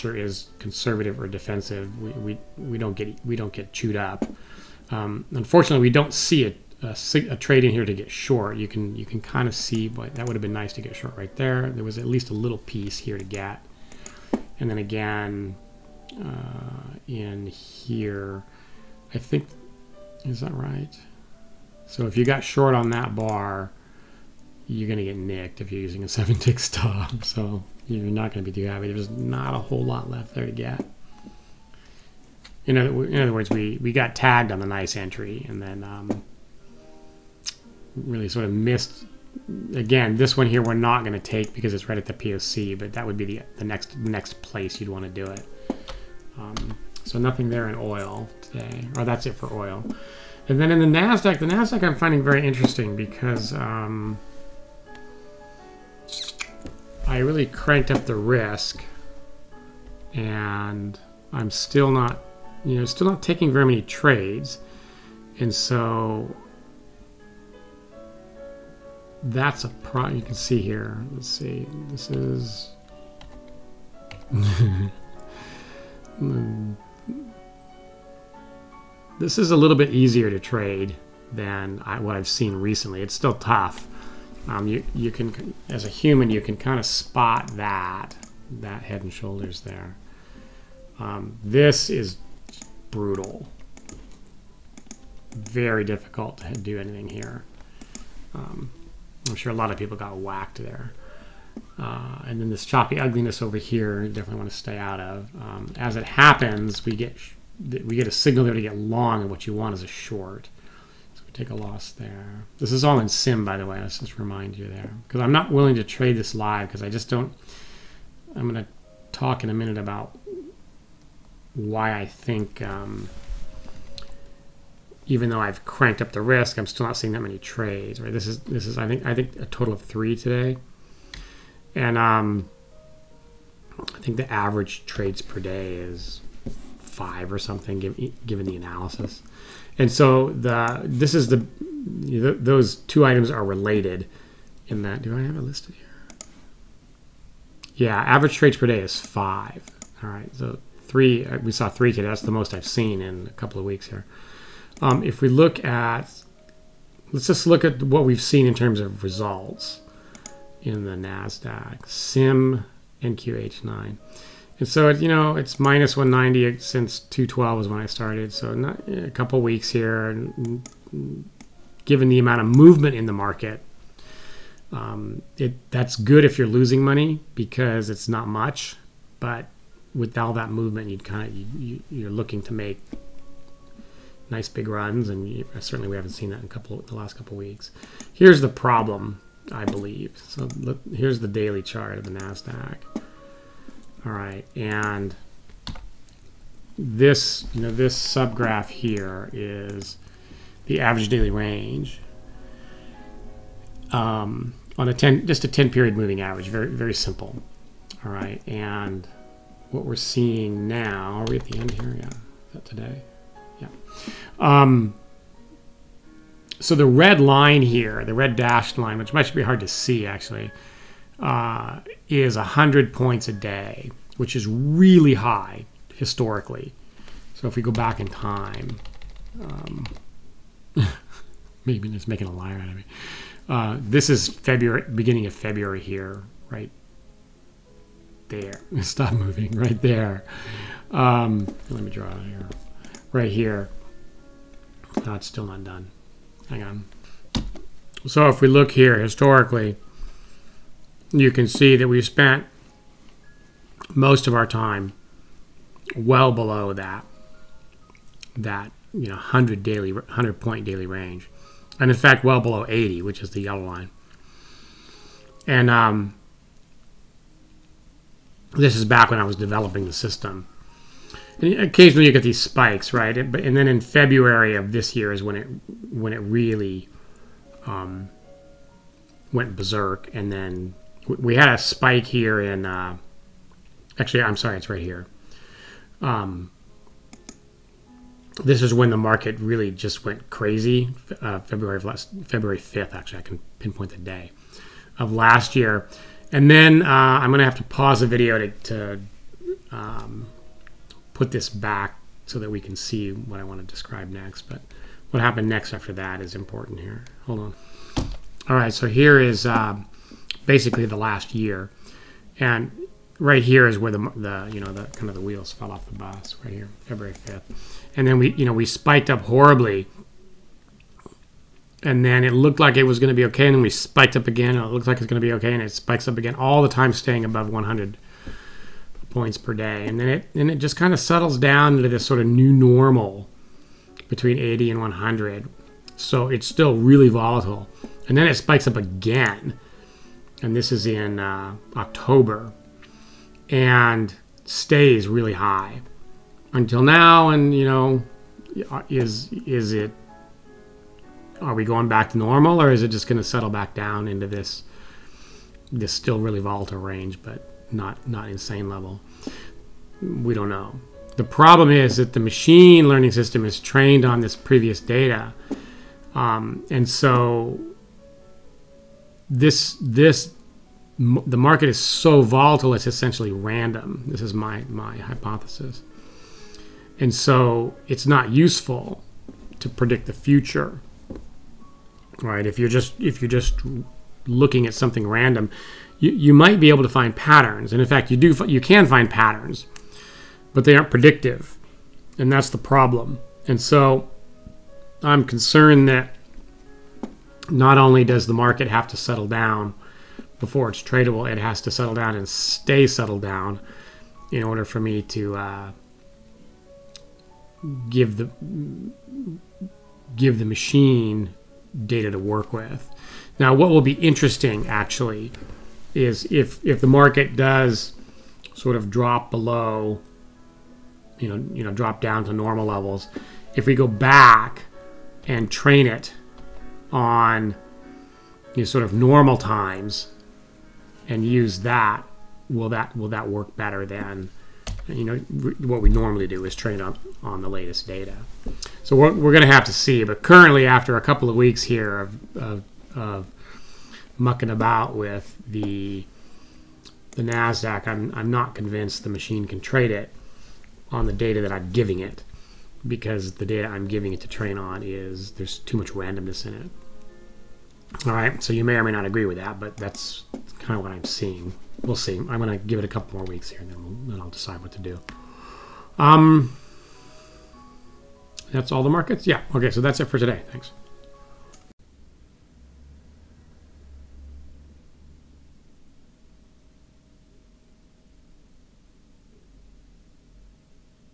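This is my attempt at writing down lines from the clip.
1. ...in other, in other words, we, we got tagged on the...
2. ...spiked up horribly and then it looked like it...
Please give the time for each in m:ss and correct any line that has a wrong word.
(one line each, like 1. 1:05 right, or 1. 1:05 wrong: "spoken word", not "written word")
1. 0:32 right
2. 5:18 right.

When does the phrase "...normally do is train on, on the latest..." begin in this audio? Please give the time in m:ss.
7:15.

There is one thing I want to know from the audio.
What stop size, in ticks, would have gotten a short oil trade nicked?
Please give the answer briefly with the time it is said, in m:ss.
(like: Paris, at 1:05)
7-tick, at 0:26.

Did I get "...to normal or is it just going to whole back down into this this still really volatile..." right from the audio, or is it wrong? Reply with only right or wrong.
wrong.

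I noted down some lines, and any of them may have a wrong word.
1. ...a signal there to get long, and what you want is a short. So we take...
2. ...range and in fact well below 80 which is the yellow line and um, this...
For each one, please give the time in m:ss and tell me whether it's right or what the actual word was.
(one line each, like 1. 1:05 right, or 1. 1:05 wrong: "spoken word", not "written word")
1. 1:48 right
2. 4:20 right.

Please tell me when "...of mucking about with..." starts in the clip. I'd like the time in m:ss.
7:22.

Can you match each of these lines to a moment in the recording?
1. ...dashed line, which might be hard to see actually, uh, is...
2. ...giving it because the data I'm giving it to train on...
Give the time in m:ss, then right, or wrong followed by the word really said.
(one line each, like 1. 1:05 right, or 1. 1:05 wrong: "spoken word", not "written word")
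1. 3:38 right
2. 7:31 right.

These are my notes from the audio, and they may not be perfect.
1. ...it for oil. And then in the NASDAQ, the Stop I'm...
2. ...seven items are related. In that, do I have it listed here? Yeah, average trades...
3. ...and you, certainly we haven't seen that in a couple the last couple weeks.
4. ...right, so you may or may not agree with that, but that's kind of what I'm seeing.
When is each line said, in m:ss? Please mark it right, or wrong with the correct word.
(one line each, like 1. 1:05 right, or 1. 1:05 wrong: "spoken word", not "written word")
1. 0:49 wrong: "NASDAQ", not "Stop"
2. 2:22 wrong: "two", not "seven"
3. 3:05 right
4. 7:38 right.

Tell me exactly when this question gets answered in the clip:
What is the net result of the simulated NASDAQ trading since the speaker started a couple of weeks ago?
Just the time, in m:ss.
2:45.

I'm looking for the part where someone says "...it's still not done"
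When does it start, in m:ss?
4:05.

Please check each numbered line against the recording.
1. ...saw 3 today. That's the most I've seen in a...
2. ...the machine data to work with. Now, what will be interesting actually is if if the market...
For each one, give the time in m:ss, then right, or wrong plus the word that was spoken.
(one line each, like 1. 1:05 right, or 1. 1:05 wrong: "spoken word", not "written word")
1. 2:31 right
2. 6:50 right.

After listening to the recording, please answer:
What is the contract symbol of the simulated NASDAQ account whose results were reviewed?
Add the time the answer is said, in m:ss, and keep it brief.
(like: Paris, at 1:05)
NQH9, at 2:43.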